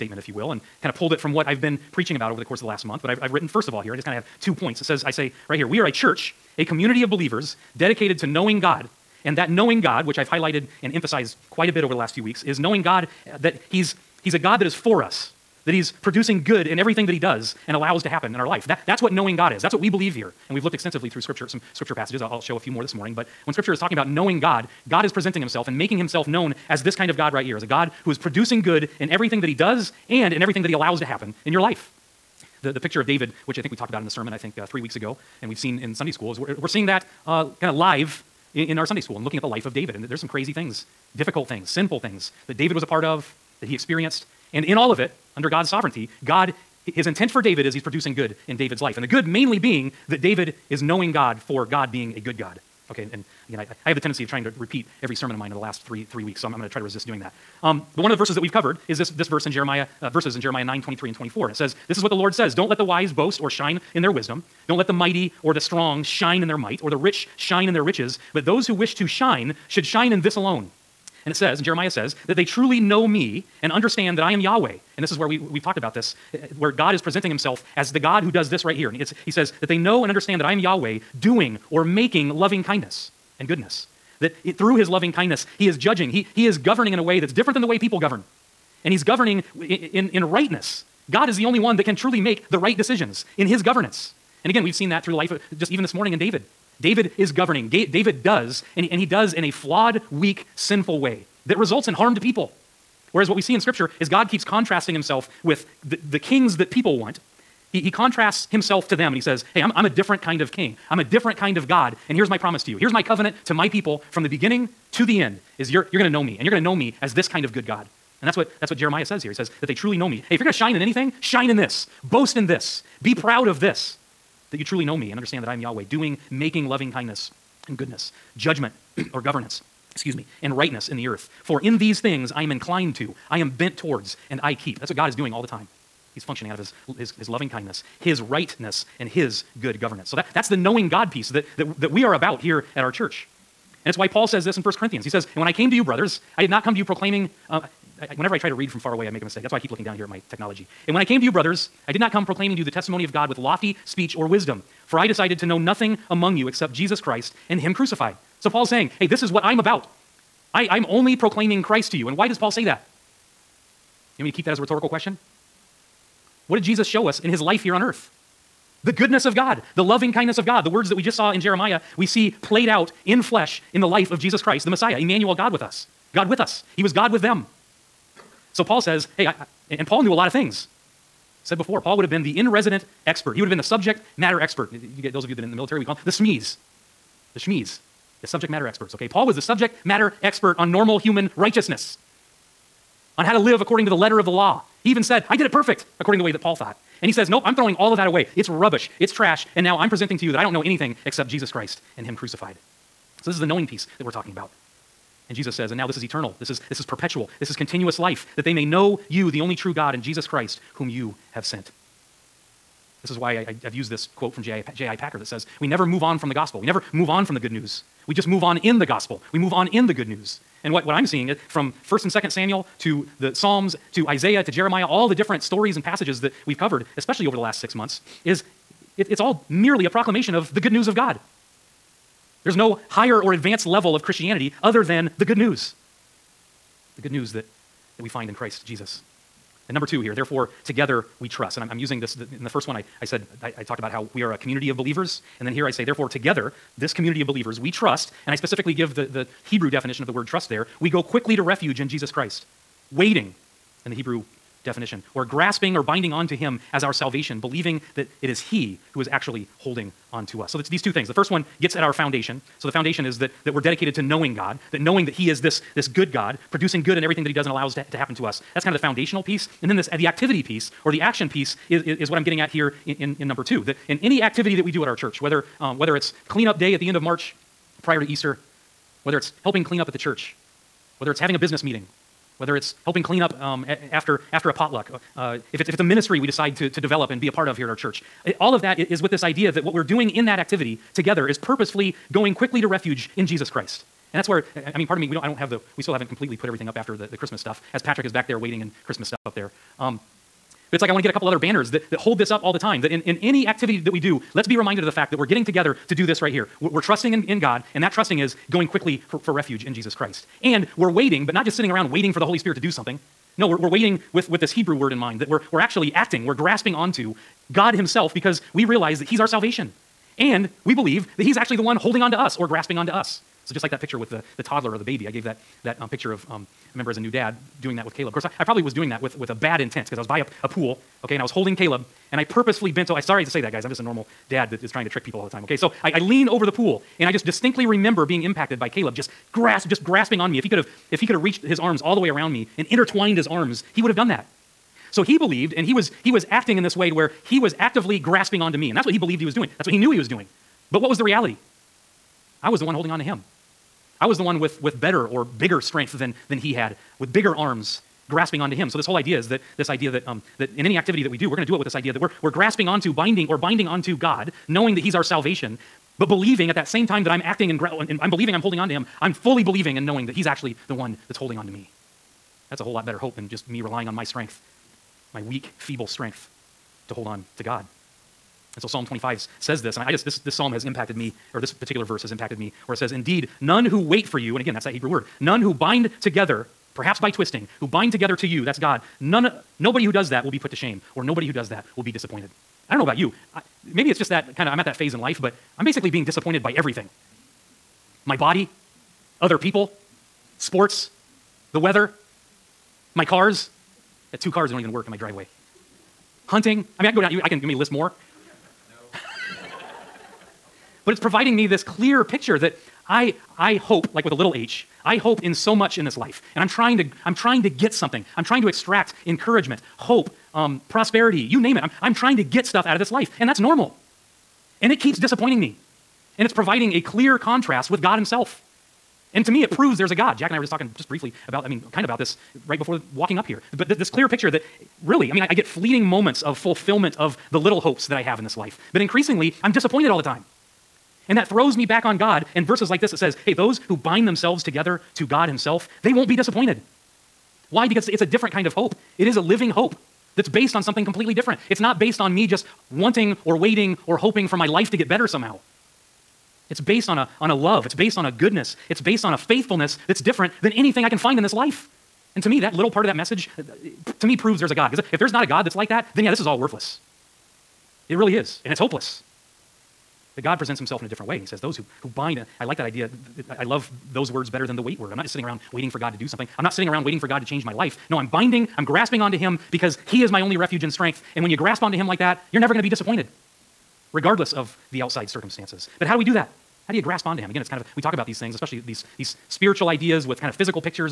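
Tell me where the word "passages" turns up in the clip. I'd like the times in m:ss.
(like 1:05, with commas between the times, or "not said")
0:21, 3:45.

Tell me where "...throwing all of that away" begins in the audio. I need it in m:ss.
3:17.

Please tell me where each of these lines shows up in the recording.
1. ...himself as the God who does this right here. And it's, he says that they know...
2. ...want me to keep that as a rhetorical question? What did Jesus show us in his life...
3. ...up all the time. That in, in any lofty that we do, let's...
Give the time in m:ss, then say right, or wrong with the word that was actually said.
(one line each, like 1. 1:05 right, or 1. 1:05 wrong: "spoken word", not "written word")
1. 1:17 right
2. 2:44 right
3. 5:02 wrong: "activity", not "lofty".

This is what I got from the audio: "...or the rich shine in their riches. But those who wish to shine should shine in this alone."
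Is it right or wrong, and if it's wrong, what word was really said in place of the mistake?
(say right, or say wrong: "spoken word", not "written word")
right.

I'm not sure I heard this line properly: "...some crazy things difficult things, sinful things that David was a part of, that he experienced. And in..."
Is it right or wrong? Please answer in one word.
right.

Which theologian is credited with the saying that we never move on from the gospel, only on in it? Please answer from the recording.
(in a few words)
J.I. Packer.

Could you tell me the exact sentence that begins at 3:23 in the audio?
So, this is the knowing piece that we're talking about.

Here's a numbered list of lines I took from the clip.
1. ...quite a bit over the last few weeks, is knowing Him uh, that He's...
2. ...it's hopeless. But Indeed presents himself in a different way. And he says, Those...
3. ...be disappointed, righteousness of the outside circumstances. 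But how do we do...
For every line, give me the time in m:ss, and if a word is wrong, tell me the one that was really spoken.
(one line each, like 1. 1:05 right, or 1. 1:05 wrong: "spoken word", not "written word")
1. 0:11 wrong: "God", not "Him"
2. 7:48 wrong: "God", not "Indeed"
3. 8:02 wrong: "regardless", not "righteousness".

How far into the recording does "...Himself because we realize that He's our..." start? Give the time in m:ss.
5:17.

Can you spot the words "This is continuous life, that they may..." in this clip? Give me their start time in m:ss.
3:27.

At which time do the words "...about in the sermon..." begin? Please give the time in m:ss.
0:33.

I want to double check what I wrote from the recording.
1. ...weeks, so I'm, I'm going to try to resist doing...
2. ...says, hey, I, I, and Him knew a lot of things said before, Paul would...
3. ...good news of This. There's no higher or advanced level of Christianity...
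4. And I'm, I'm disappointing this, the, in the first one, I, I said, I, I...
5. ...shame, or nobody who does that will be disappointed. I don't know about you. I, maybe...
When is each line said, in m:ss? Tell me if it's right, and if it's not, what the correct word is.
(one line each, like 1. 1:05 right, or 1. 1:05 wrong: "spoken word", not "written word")
1. 0:56 right
2. 2:58 wrong: "Paul", not "Him"
3. 3:50 wrong: "God", not "This"
4. 4:01 wrong: "using", not "disappointing"
5. 6:30 right.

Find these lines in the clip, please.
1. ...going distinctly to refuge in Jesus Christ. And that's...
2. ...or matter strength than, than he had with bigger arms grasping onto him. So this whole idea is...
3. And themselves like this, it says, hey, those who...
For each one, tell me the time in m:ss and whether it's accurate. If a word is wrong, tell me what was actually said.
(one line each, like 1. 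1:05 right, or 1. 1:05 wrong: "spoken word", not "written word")
1. 4:52 wrong: "quickly", not "distinctly"
2. 5:55 wrong: "bigger", not "matter"
3. 7:22 wrong: "verses", not "themselves".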